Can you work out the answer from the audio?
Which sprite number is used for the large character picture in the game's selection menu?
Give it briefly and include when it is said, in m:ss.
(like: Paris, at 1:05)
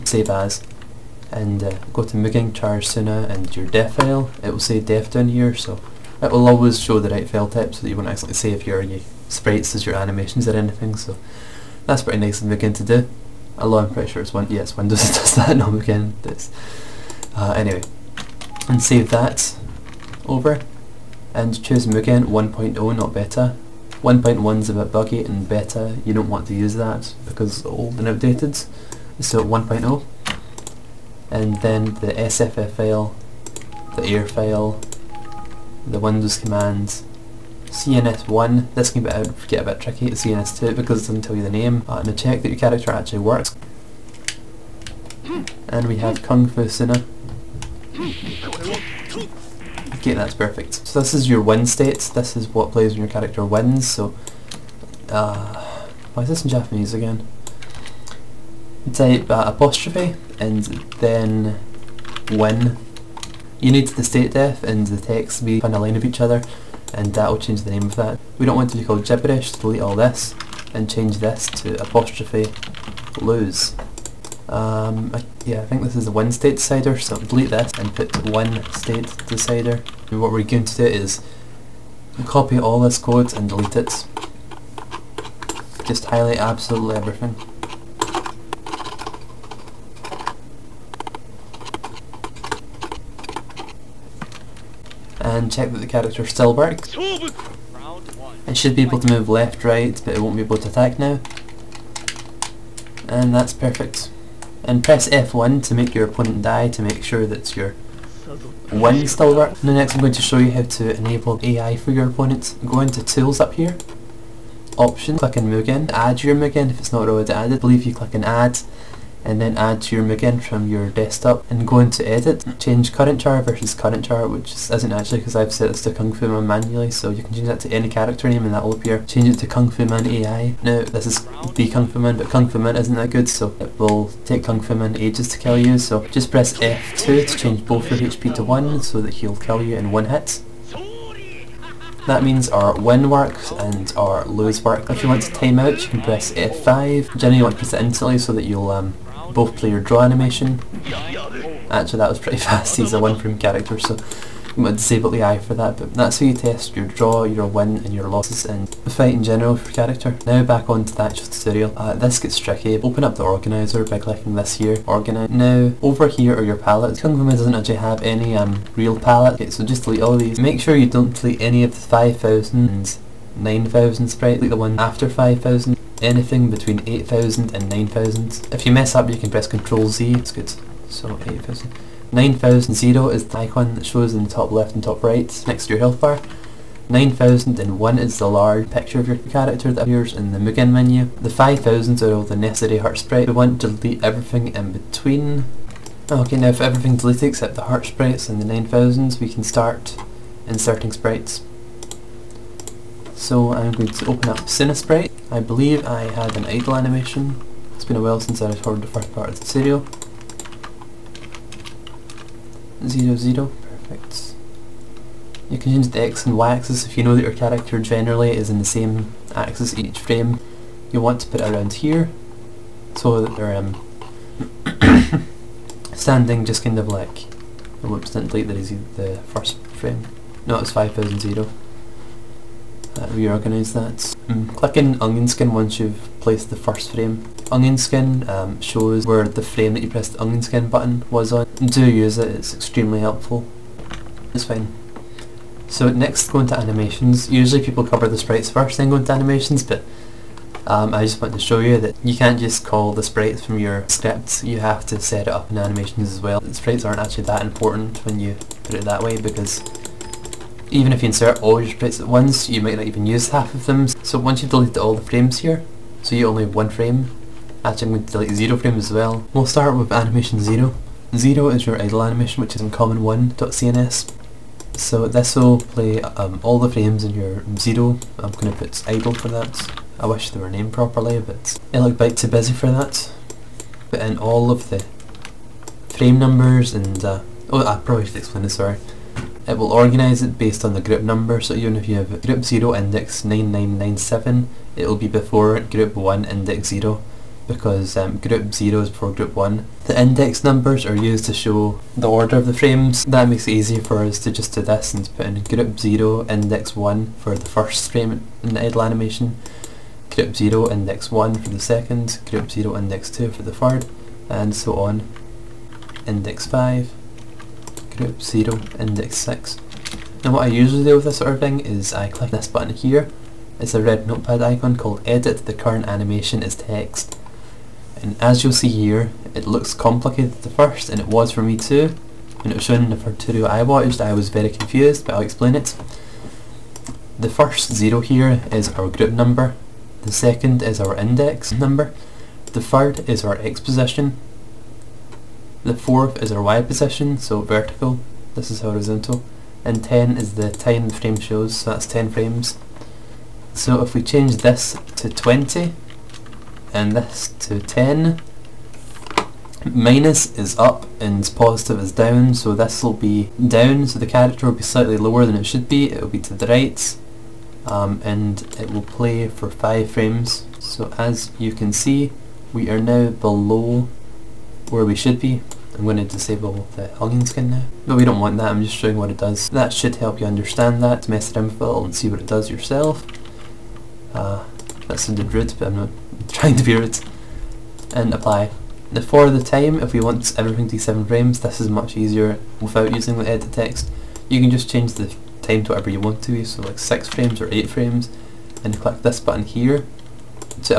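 9001, at 3:06.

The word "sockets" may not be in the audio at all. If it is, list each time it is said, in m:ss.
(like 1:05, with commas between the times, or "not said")
not said.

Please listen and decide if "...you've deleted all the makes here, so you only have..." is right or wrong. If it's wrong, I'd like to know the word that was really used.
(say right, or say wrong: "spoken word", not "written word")
wrong: "frames", not "makes".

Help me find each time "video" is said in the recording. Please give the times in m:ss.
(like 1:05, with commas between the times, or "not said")
3:29.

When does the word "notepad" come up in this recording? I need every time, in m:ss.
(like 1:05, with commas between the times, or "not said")
5:24.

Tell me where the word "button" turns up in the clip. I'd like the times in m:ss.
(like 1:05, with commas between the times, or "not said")
4:00, 5:22, 6:39.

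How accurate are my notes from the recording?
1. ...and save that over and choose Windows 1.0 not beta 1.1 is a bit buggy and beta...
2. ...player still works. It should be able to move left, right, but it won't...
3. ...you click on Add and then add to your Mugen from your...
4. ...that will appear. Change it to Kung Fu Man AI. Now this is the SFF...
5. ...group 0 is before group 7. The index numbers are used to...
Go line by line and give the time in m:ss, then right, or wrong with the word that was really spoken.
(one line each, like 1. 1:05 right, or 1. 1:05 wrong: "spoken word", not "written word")
1. 0:18 wrong: "Mugen", not "Windows"
2. 1:35 wrong: "character", not "player"
3. 1:57 right
4. 2:08 wrong: "Kung", not "SFF"
5. 4:58 wrong: "1", not "7".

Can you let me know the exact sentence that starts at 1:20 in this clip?
And what we're going to do is copy all this code and delete it.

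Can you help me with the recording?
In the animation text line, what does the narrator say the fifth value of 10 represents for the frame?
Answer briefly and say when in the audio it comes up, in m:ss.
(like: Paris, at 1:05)
Time the frame shows, at 5:50.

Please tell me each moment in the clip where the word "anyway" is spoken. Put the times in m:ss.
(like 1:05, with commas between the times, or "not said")
0:17.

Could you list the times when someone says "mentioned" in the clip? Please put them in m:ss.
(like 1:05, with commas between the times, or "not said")
not said.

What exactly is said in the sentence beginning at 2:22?
That means our win works and our lose work.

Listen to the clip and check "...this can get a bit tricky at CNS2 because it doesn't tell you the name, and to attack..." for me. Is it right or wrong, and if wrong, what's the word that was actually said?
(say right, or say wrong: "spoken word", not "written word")
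wrong: "check", not "attack".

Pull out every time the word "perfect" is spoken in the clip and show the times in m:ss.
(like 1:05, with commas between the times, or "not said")
0:50, 1:43, 3:33.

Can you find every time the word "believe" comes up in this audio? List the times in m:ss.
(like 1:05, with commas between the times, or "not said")
1:57, 3:25.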